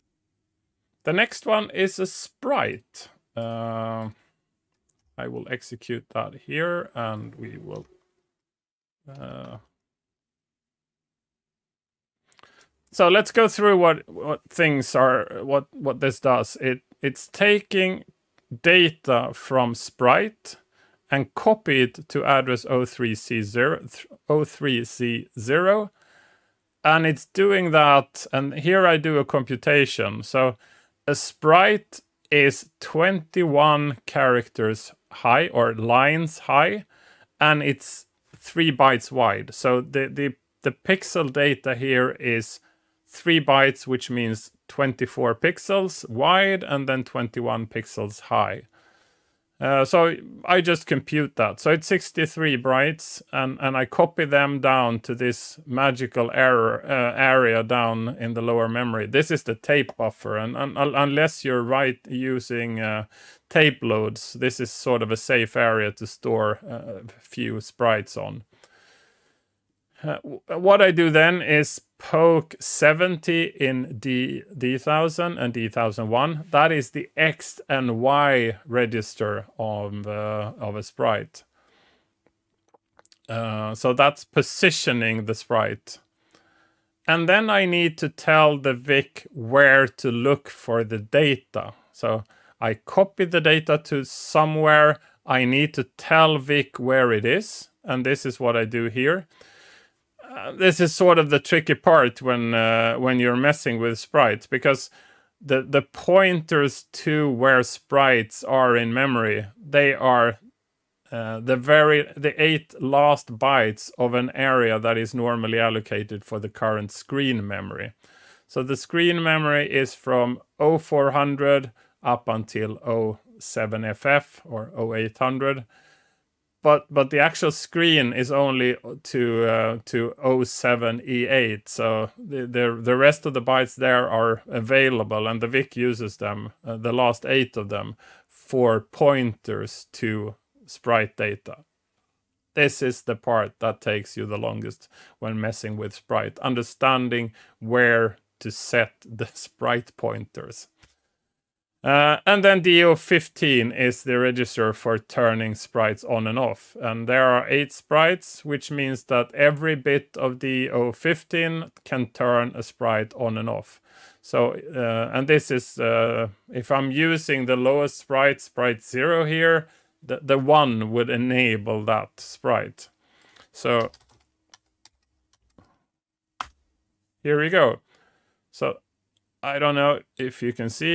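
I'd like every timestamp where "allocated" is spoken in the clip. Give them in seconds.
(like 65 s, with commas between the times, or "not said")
115 s.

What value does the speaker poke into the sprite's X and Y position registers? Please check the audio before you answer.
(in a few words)
70.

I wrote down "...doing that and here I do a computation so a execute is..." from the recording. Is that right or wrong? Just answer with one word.
wrong.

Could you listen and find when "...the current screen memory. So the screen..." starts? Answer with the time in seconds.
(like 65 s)
116 s.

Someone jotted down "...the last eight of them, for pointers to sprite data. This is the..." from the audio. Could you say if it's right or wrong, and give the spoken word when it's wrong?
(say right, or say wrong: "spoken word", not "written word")
right.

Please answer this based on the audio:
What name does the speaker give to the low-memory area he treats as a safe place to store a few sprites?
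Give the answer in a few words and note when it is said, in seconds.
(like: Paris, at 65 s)
tape buffer, at 59 s.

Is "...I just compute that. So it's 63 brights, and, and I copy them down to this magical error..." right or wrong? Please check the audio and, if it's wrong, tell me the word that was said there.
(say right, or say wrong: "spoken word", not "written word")
right.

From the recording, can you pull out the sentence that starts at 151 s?
Uh, and then DO15 is the register for turning sprites on and off.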